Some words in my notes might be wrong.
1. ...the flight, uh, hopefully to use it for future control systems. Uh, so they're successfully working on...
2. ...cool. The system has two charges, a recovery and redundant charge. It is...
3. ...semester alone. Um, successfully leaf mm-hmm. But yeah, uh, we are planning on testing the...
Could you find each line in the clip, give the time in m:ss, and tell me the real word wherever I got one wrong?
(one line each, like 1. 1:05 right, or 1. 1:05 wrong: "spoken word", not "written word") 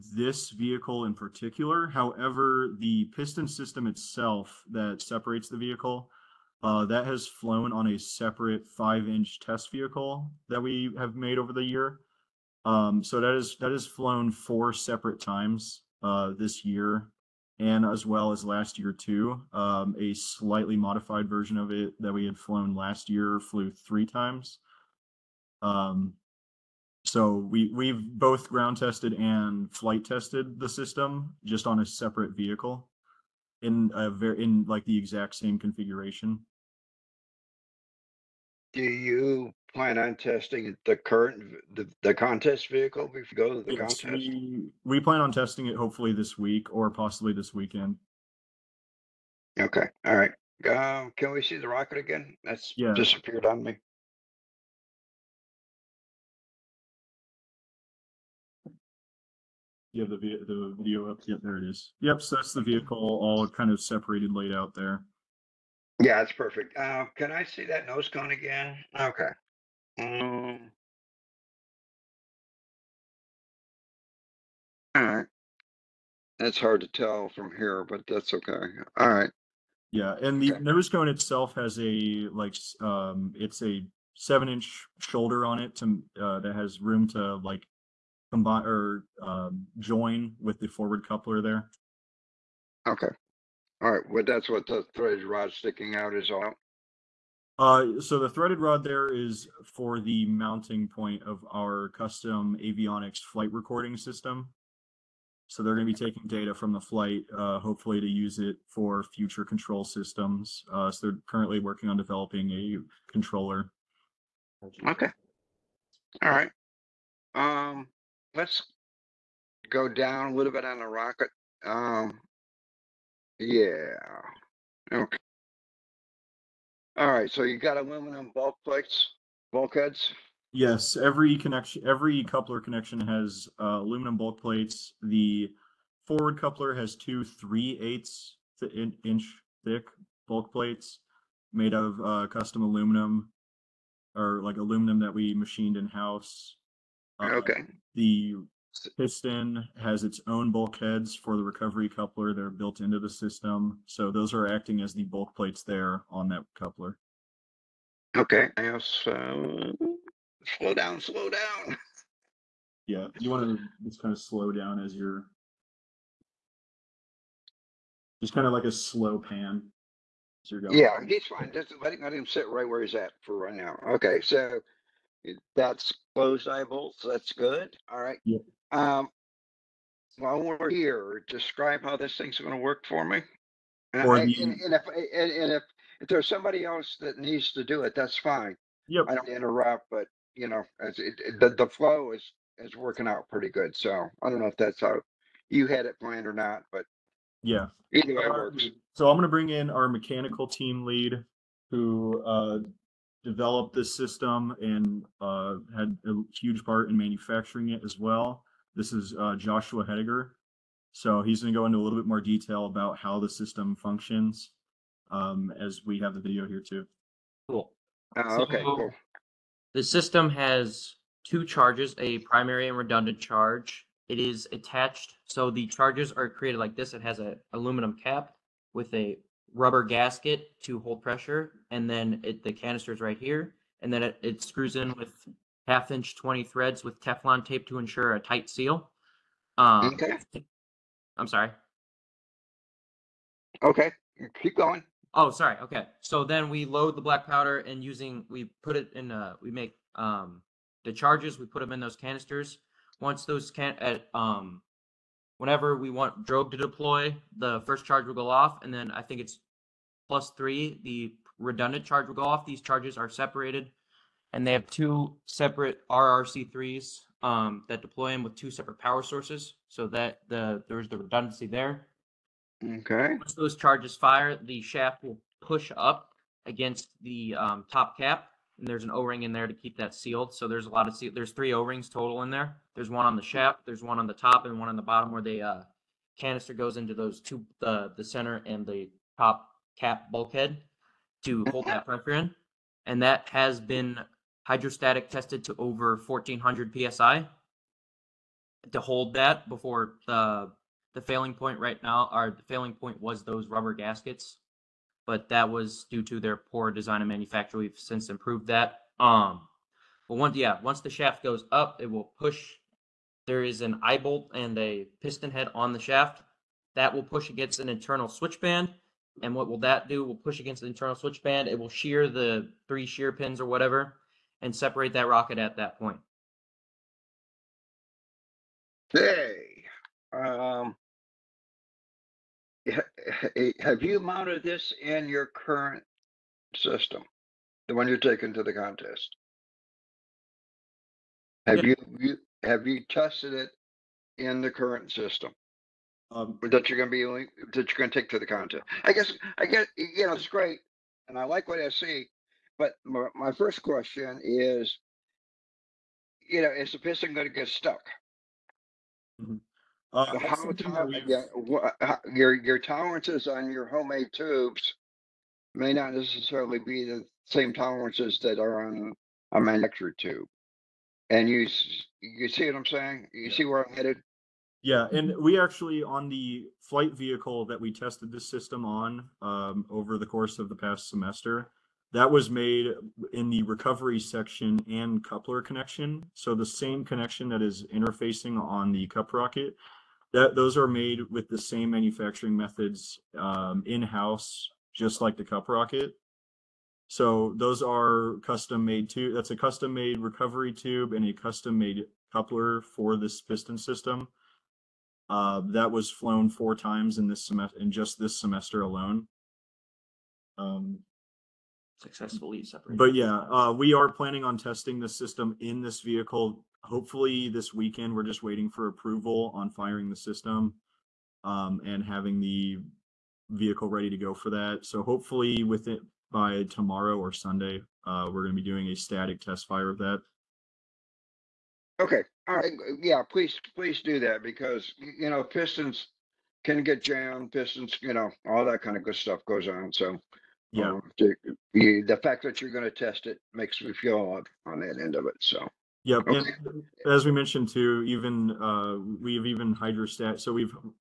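1. 1:46 wrong: "currently", not "successfully"
2. 3:38 wrong: "primary", not "recovery"
3. 6:48 right.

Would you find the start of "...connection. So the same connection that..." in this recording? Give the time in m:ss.
6:25.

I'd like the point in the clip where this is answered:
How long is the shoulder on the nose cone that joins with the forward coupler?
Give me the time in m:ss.
1:24.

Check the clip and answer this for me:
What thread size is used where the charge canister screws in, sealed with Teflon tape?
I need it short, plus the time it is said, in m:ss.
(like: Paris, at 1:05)
1/2-20, at 3:55.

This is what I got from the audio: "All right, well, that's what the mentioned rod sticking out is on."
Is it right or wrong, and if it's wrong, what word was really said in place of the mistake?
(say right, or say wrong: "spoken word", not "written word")
wrong: "threaded", not "mentioned".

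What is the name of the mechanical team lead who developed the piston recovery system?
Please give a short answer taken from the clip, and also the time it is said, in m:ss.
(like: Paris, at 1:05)
Joshua Hediger, at 3:29.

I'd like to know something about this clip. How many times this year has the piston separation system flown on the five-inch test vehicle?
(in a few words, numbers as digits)
4.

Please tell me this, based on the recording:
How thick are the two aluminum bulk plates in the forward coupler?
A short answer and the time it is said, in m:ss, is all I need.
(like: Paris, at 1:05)
3/8 inch, at 2:17.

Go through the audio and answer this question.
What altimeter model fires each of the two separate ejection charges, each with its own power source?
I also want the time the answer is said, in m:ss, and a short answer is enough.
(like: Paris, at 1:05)
RRC3, at 4:25.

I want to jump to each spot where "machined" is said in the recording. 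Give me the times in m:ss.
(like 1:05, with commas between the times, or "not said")
2:25.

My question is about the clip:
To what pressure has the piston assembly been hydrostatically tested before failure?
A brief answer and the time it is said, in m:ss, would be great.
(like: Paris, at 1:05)
1400 psi, at 4:56.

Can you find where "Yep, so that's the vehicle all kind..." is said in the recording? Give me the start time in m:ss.
1:01.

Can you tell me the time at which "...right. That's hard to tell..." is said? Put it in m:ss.
1:15.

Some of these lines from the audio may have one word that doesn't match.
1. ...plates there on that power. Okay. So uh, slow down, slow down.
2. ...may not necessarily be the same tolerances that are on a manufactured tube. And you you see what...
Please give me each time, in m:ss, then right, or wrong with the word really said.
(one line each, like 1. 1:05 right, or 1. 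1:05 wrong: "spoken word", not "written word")
1. 2:35 wrong: "coupler", not "power"
2. 6:05 right.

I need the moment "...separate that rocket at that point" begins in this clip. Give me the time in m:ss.
5:24.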